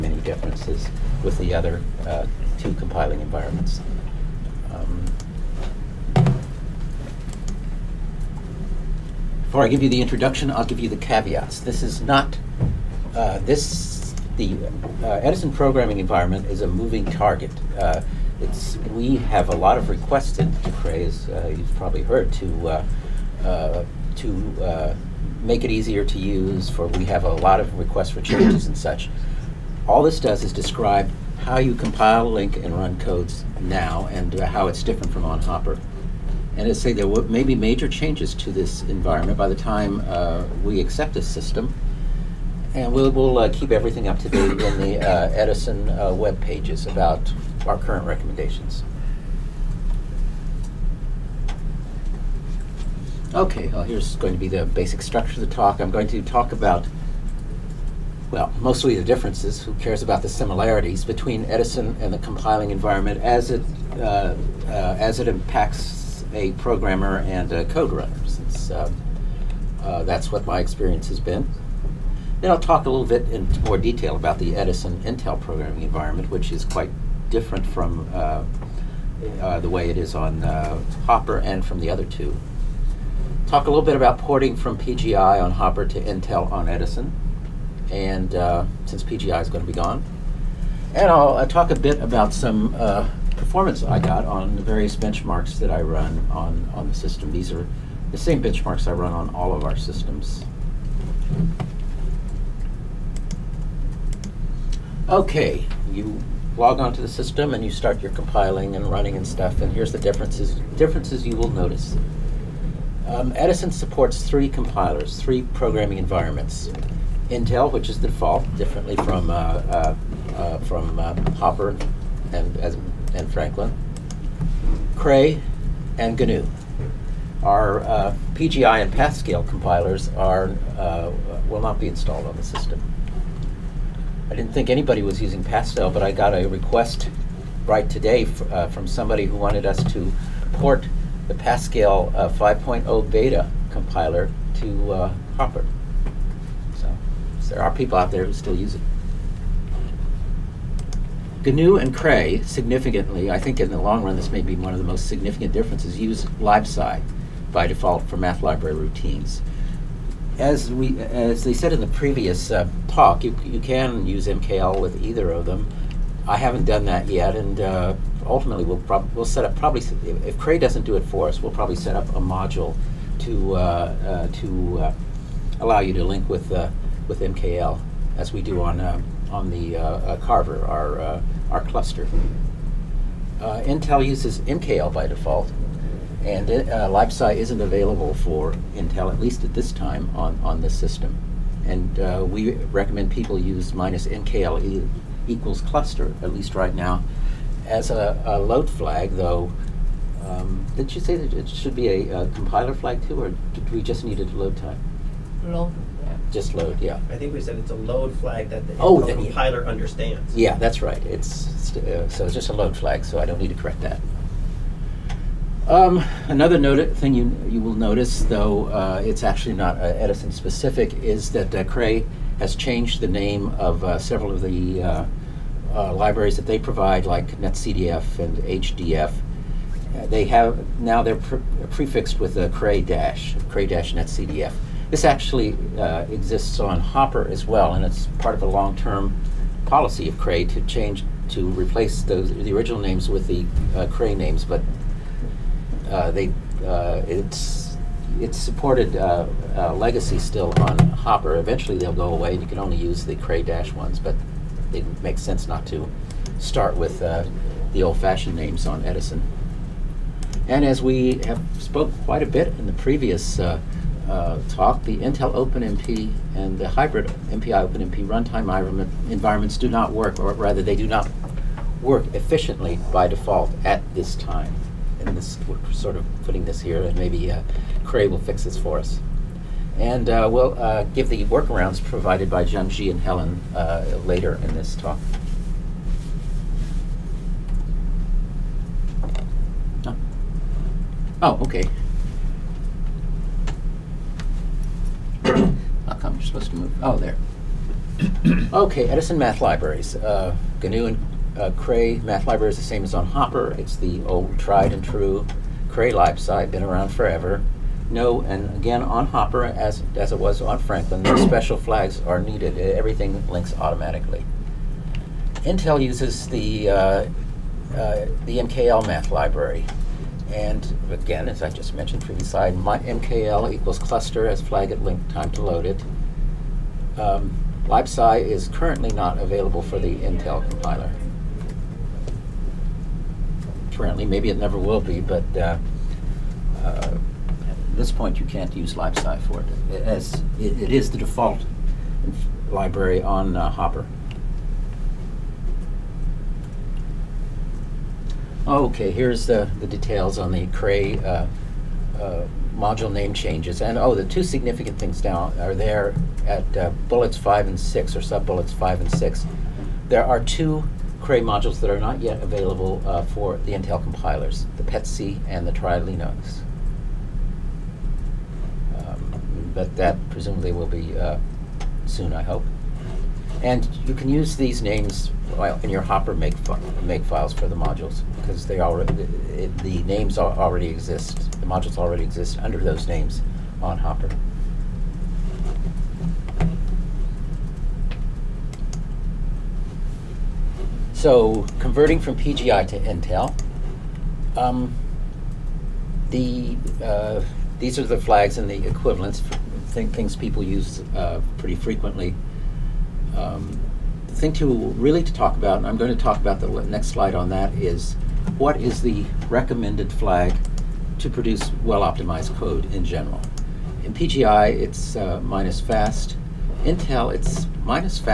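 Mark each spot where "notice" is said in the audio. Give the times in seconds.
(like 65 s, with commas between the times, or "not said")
111 s, 217 s.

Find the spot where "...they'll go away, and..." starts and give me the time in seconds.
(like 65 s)
251 s.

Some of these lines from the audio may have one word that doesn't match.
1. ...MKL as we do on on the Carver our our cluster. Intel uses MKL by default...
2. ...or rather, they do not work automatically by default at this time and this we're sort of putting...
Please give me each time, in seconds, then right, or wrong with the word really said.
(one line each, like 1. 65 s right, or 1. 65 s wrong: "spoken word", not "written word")
1. 177 s right
2. 270 s wrong: "efficiently", not "automatically".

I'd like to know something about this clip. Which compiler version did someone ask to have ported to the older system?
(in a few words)
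5.0 beta.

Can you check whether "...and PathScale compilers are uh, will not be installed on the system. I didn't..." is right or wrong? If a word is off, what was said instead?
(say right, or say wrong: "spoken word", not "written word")
right.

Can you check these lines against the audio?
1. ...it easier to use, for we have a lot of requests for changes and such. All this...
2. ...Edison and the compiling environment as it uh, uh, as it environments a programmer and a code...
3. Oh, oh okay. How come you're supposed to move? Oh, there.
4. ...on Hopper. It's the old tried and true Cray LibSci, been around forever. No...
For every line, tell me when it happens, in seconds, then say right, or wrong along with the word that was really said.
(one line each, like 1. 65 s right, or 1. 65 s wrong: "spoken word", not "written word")
1. 25 s right
2. 61 s wrong: "impacts", not "environments"
3. 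289 s right
4. 302 s right.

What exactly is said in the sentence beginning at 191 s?
And uh, we recommend people use minus MKL equals cluster, at least right now, as a, a load flag, though.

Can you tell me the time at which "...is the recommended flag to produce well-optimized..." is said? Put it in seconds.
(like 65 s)
408 s.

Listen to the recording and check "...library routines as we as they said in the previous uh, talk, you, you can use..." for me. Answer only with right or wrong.
right.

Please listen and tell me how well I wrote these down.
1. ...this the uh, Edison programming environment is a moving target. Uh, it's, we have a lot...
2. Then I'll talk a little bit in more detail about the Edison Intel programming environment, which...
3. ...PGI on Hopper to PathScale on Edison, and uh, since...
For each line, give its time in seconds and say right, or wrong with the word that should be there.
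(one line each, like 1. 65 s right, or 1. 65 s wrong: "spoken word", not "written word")
1. 13 s right
2. 72 s right
3. 84 s wrong: "Intel", not "PathScale".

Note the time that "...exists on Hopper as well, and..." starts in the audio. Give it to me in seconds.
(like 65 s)
236 s.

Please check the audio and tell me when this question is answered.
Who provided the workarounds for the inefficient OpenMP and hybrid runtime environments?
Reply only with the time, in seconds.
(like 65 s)
282 s.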